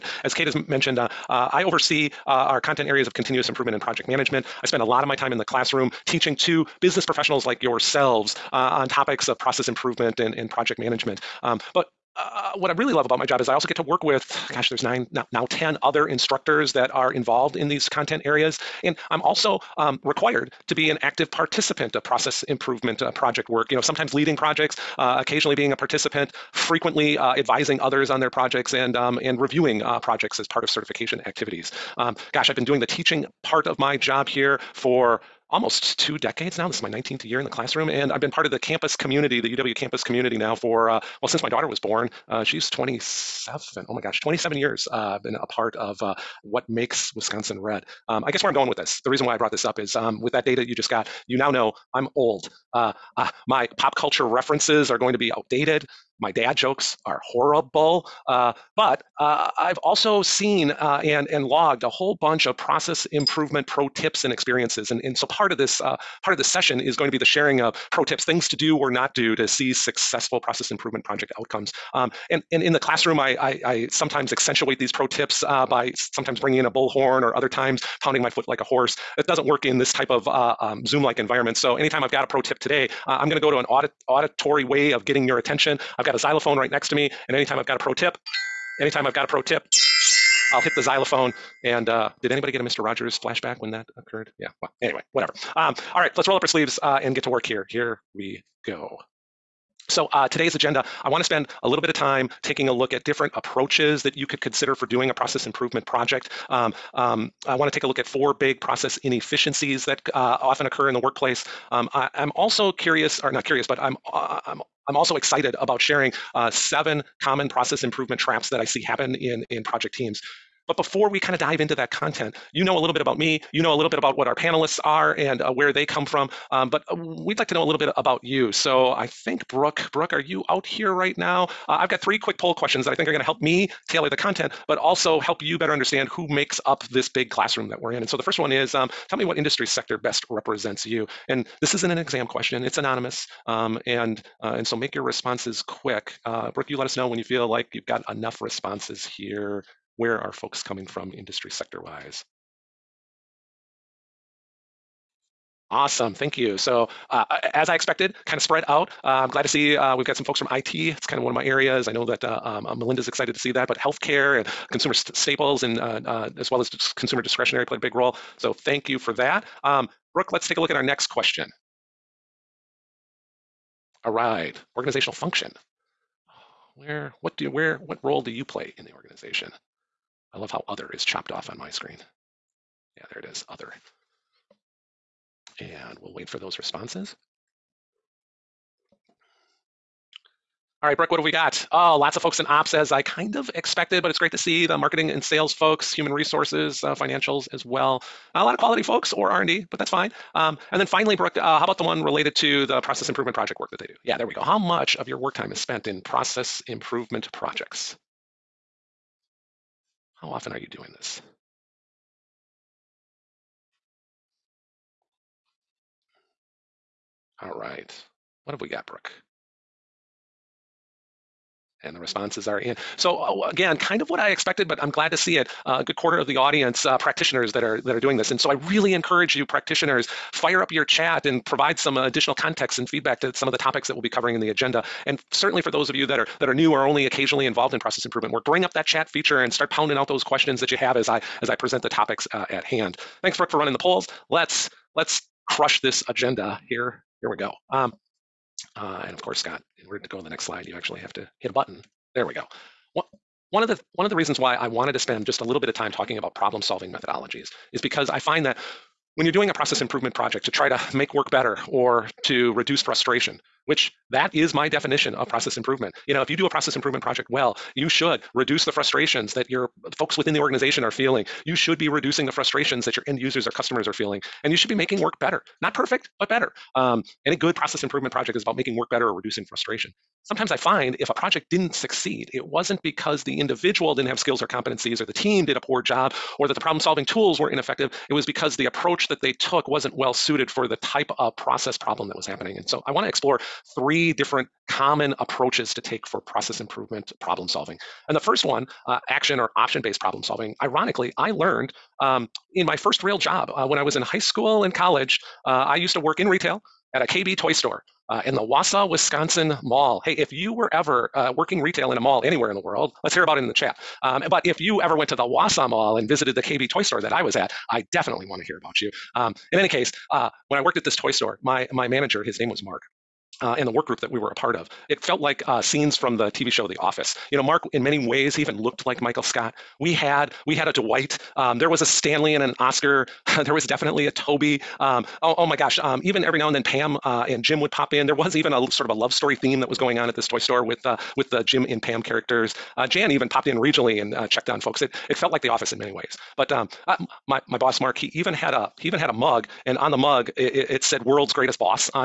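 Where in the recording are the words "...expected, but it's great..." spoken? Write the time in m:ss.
3:13.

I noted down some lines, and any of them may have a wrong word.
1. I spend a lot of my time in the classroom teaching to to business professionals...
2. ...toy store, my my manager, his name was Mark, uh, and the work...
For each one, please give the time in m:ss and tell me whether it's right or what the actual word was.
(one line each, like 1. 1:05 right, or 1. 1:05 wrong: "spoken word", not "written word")
1. 0:04 right
2. 5:20 right.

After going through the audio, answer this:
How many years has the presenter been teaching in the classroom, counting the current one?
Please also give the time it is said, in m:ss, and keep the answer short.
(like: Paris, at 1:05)
19, at 0:36.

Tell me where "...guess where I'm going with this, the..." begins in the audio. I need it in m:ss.
0:48.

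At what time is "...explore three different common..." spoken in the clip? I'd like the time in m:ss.
4:53.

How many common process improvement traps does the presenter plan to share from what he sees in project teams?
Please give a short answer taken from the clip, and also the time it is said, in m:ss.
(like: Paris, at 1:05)
7, at 1:56.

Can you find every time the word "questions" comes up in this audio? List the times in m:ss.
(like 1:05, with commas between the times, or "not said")
2:12, 2:22, 2:51, 4:00.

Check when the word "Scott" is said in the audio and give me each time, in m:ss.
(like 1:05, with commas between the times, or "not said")
4:09, 5:29.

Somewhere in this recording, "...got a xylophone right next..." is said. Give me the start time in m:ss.
1:26.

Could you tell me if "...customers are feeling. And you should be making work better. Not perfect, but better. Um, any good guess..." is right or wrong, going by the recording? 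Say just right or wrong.
wrong.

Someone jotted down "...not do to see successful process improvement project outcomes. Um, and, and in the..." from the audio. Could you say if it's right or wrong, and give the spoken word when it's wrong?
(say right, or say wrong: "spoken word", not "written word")
right.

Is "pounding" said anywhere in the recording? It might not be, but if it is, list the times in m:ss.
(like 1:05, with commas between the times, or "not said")
1:18, 3:59.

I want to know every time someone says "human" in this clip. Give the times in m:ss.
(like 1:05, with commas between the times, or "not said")
3:15.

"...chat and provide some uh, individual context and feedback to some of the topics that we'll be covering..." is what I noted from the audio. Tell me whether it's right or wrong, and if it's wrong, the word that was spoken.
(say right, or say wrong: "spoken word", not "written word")
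wrong: "additional", not "individual".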